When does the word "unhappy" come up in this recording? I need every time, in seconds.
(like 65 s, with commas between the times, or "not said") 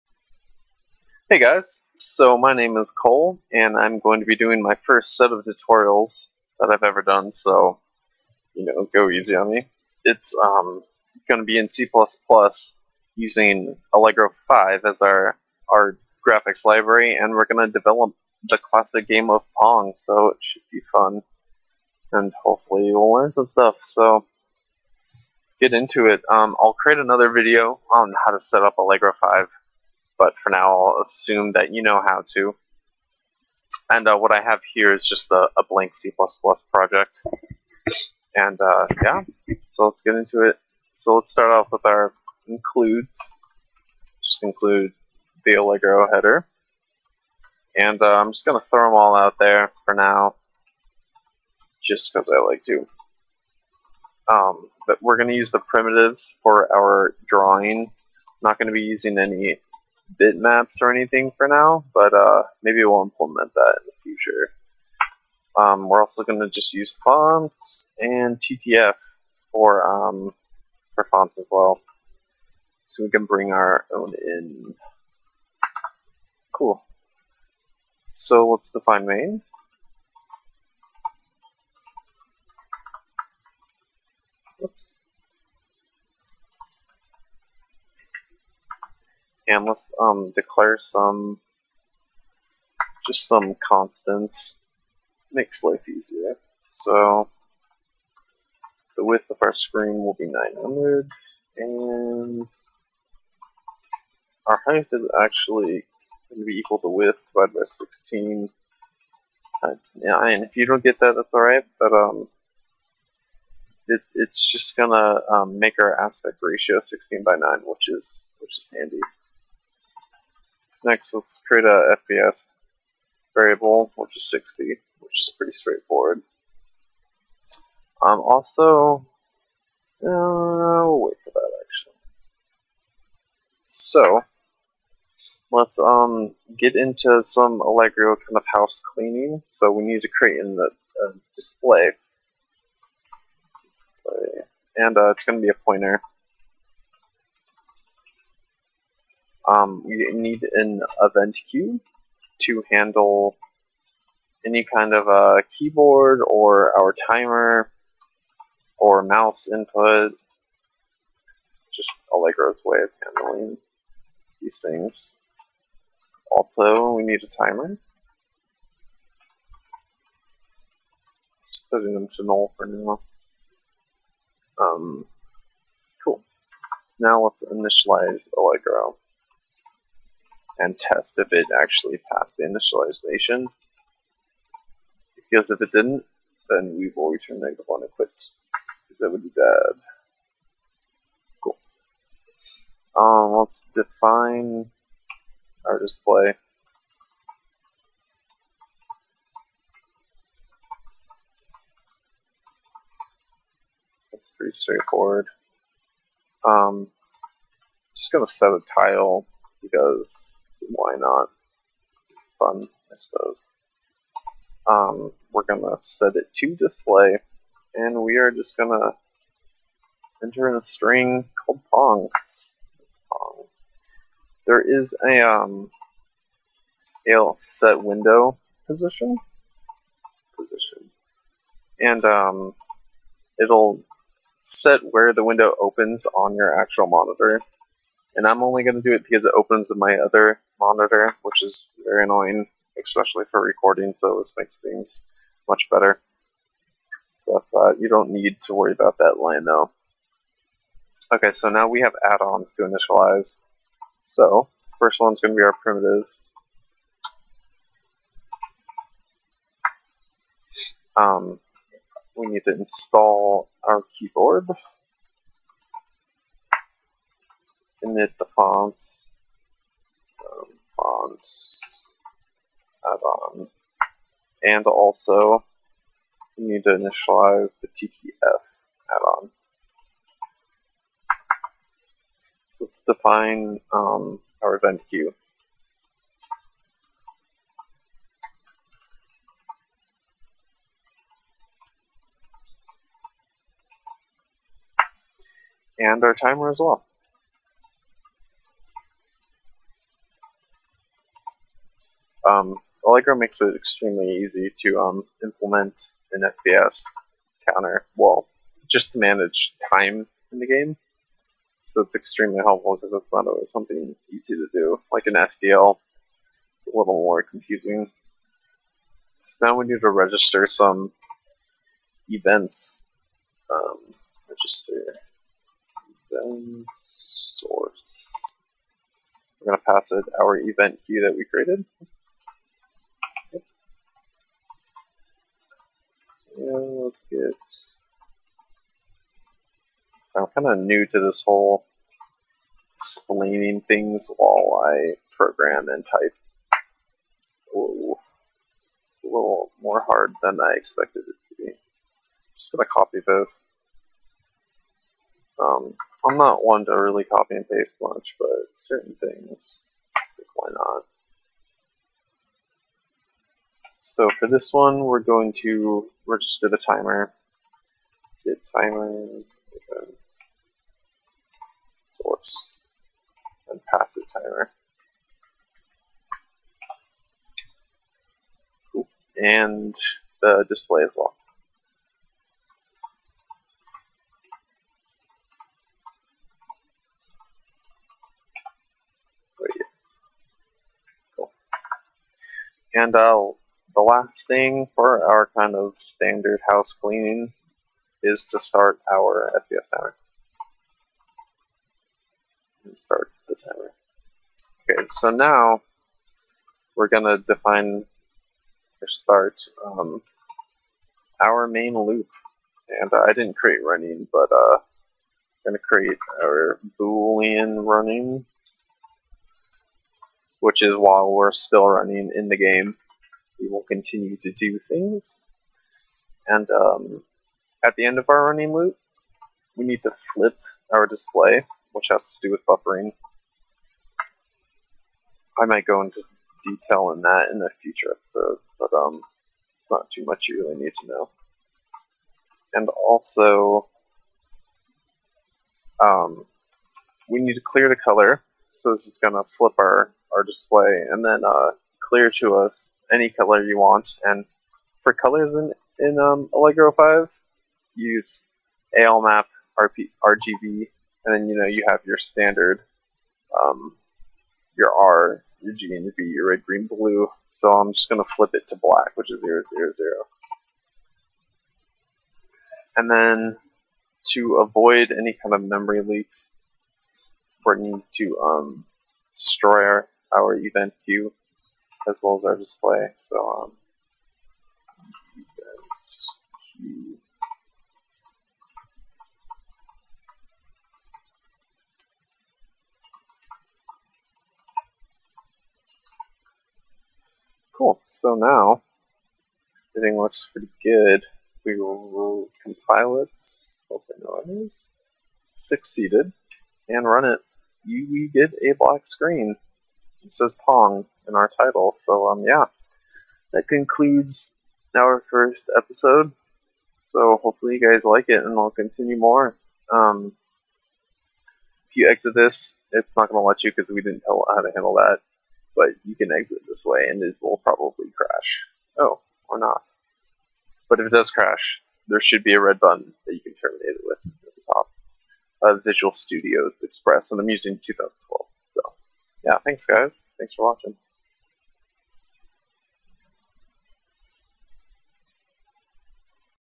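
not said.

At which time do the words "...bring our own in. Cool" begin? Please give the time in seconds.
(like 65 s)
73 s.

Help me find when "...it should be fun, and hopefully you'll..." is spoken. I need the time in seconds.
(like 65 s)
20 s.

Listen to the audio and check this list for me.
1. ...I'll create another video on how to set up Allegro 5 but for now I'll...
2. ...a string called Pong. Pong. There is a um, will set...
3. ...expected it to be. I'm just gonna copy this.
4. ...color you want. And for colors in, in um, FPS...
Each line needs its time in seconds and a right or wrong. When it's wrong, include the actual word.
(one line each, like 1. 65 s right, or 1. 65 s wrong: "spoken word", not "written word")
1. 26 s right
2. 220 s right
3. 350 s right
4. 453 s wrong: "Allegro", not "FPS".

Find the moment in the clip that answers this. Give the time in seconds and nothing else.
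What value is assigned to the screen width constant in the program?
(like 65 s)
100 s.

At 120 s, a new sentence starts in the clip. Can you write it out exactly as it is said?
Next, let's create a FPS variable, which is 60, which is pretty straightforward.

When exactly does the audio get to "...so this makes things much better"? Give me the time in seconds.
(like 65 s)
243 s.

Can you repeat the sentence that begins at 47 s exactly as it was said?
And uh, I'm just going to throw them all out there for now, just because I like to.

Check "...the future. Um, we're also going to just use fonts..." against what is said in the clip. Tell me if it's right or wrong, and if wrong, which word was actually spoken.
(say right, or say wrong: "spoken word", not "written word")
right.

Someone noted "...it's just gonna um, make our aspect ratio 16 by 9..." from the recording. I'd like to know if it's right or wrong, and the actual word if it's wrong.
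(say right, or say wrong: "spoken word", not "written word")
right.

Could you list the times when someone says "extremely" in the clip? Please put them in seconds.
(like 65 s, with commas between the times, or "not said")
303 s, 311 s.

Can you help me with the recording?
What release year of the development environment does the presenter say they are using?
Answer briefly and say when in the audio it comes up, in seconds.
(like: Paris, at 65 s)
2012, at 537 s.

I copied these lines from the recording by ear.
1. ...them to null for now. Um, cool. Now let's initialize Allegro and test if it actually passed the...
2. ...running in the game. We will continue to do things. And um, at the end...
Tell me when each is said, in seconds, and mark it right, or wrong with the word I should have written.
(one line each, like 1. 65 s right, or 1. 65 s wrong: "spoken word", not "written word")
1. 171 s right
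2. 421 s right.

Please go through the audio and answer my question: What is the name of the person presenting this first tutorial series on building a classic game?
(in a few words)
Cole.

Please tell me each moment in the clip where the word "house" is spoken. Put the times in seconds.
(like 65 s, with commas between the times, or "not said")
138 s, 396 s.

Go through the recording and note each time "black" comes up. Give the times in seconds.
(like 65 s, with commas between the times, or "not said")
468 s, 508 s.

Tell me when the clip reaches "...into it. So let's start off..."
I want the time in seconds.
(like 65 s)
40 s.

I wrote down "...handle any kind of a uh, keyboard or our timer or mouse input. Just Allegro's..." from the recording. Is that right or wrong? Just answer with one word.
right.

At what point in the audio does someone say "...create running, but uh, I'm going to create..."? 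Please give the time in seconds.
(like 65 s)
413 s.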